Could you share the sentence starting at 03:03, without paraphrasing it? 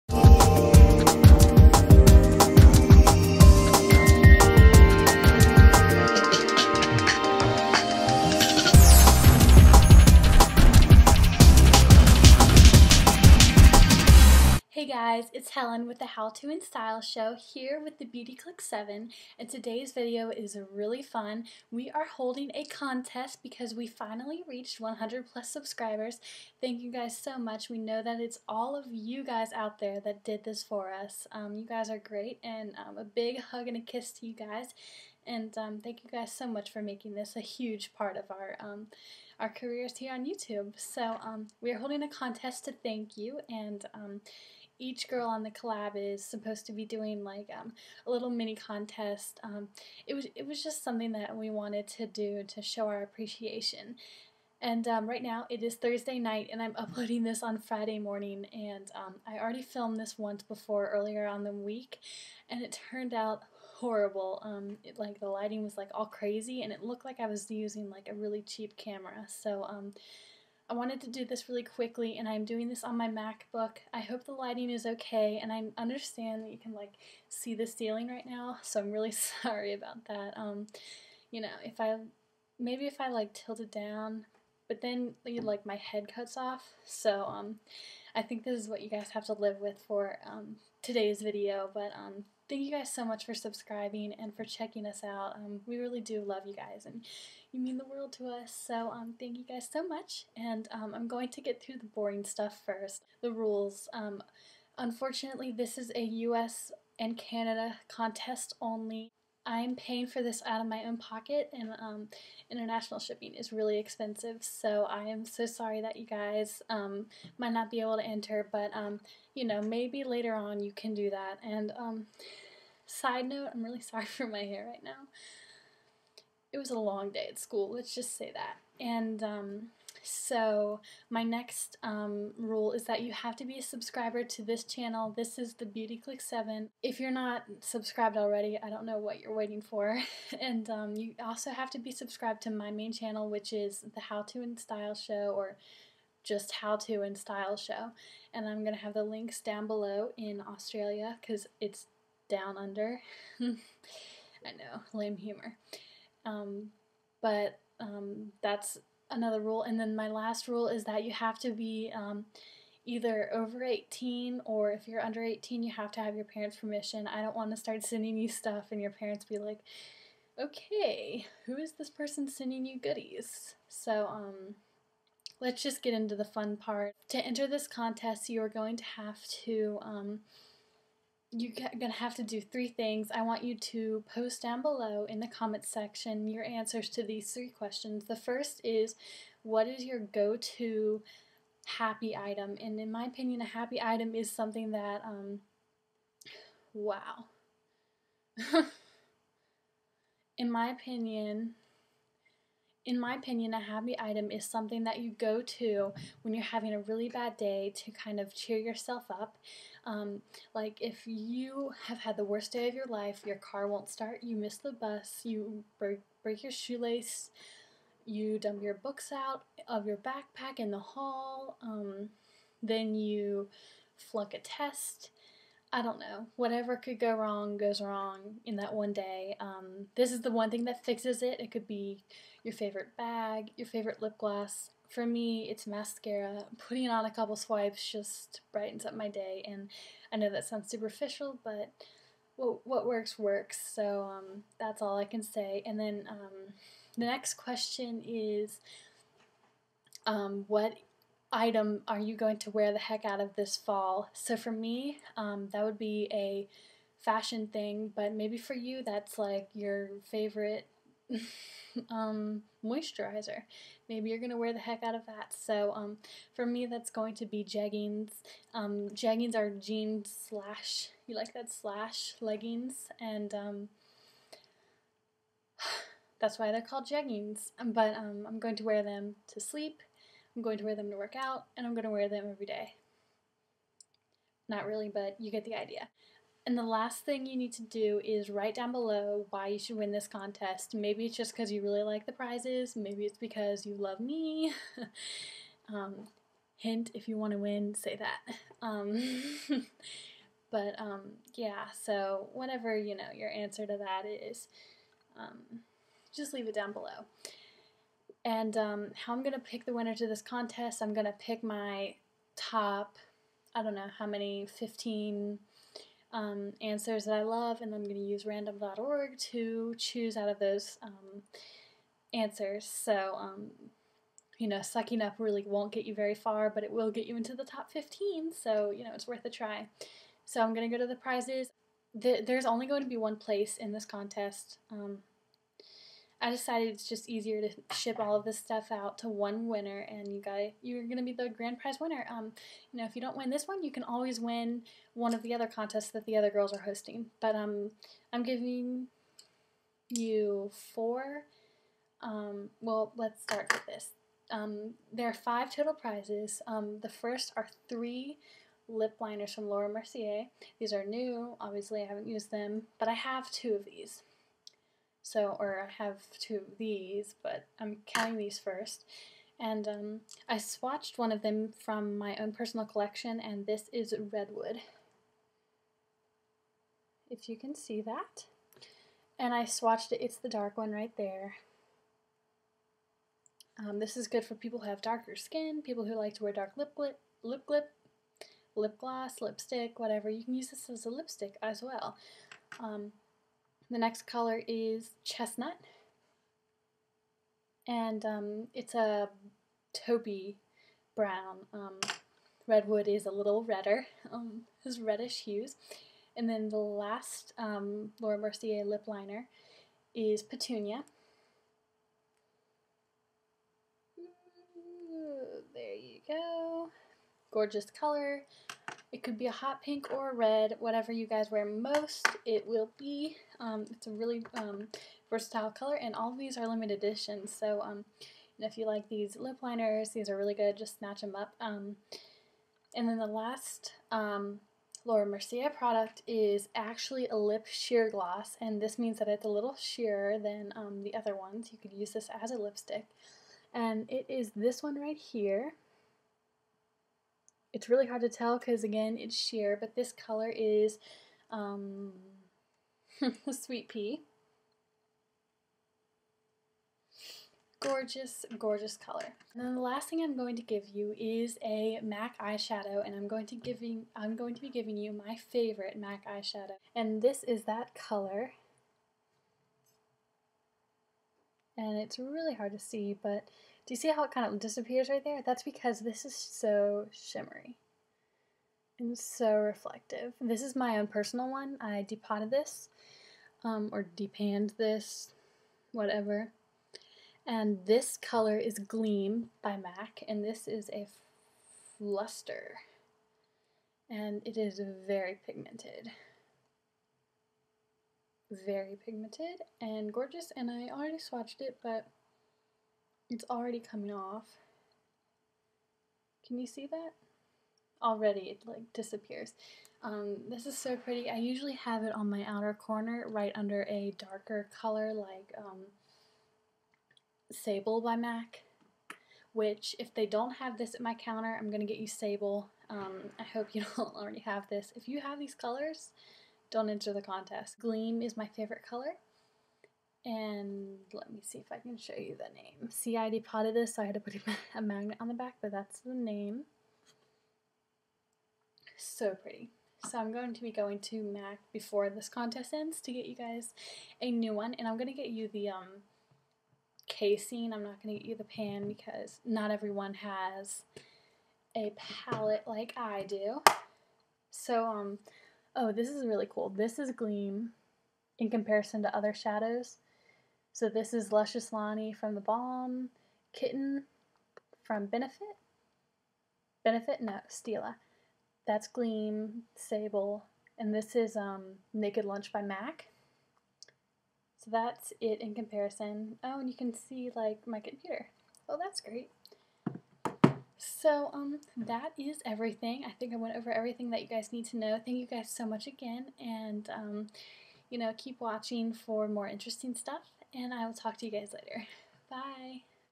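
I want you to post down below in the comments section your answers to these three questions.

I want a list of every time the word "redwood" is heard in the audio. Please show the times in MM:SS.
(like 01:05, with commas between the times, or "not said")
06:14, 06:42.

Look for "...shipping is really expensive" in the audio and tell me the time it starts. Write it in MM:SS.
01:52.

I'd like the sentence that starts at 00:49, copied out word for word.
Um, it was it was just something that we wanted to do to show our appreciation.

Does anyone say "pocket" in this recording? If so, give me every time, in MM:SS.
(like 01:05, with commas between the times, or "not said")
01:50.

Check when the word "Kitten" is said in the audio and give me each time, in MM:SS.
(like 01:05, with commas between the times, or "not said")
09:23.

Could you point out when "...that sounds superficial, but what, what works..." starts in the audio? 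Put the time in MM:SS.
04:00.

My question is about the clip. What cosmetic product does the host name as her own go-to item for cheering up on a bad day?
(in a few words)
Mascara.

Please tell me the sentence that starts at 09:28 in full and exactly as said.
That's Gleam, Sable, and this is um, Naked Lunch by MAC.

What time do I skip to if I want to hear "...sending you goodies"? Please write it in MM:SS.
02:52.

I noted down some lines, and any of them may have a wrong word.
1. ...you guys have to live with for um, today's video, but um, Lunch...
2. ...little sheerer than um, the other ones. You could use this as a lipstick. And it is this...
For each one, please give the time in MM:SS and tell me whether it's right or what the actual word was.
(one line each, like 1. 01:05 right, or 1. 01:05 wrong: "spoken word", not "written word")
1. 01:28 wrong: "Thank", not "Lunch"
2. 07:19 right.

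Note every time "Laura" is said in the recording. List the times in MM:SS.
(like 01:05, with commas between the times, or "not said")
05:59, 06:48, 07:14.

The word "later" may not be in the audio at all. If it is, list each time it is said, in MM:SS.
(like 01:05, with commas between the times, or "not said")
02:00, 09:51.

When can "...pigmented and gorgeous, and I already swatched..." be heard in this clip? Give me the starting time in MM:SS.
08:18.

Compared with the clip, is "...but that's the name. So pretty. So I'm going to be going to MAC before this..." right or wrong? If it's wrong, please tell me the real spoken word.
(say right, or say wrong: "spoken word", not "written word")
right.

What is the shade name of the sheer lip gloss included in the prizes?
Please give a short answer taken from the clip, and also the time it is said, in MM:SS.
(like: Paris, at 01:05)
Sweet Pea, at 07:33.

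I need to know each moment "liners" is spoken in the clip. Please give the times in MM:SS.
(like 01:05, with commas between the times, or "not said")
05:58, 06:48, 07:09.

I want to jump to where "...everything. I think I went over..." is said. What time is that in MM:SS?
09:42.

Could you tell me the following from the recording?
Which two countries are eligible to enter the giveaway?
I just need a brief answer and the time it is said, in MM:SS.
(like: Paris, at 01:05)
U.S. and Canada, at 01:46.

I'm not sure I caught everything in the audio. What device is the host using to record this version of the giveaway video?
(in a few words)
MacBook.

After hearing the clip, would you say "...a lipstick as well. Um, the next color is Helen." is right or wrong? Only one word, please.
wrong.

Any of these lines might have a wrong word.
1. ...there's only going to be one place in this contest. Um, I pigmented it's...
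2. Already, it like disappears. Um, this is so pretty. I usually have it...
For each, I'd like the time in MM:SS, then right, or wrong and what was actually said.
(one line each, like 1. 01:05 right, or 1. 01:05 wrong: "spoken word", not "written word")
1. 05:32 wrong: "decided", not "pigmented"
2. 08:27 right.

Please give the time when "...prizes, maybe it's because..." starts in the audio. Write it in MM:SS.
04:52.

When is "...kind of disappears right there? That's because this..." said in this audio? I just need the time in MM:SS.
07:54.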